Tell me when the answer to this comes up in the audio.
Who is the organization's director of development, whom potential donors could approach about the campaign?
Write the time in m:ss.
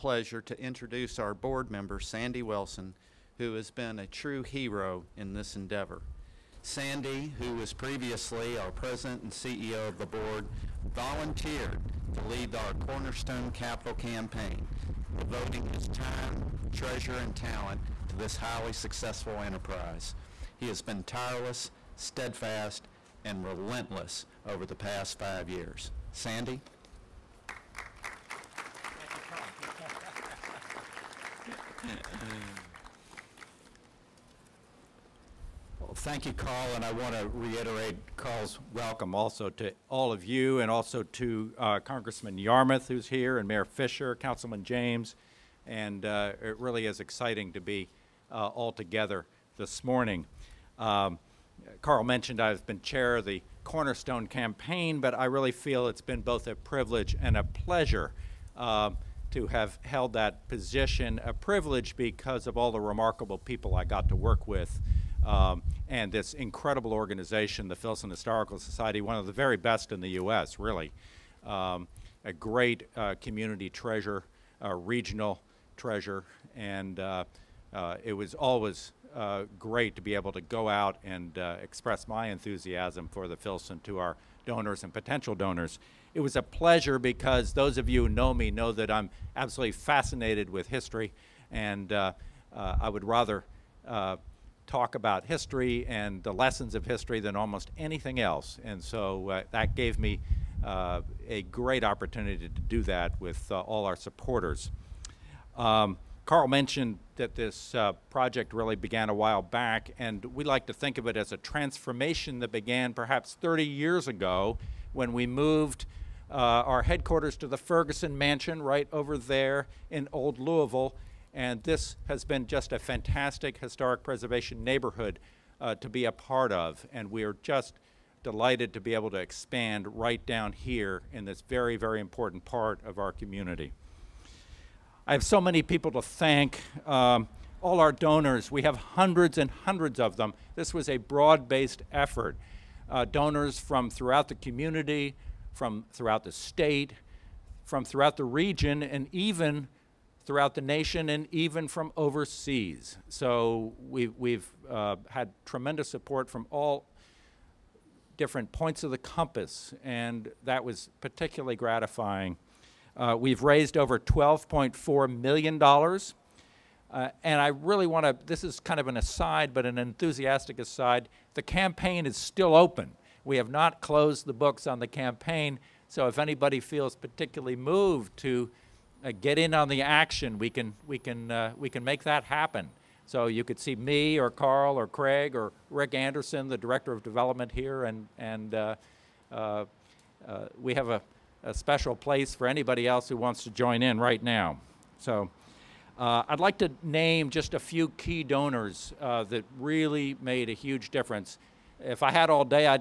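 3:05.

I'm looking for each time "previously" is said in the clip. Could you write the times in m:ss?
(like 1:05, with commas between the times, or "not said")
0:07.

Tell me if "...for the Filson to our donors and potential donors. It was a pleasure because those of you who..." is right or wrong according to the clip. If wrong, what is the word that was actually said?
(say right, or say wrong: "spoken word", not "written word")
right.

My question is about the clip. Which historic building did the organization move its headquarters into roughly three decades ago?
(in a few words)
Ferguson Mansion.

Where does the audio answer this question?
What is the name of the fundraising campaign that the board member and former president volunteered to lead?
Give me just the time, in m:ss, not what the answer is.
0:12.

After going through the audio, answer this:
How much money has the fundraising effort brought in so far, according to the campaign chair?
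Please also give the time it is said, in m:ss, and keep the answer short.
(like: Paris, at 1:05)
$12.4 million, at 2:43.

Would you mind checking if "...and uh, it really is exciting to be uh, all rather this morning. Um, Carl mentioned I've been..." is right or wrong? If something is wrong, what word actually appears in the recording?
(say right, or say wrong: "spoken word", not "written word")
wrong: "together", not "rather".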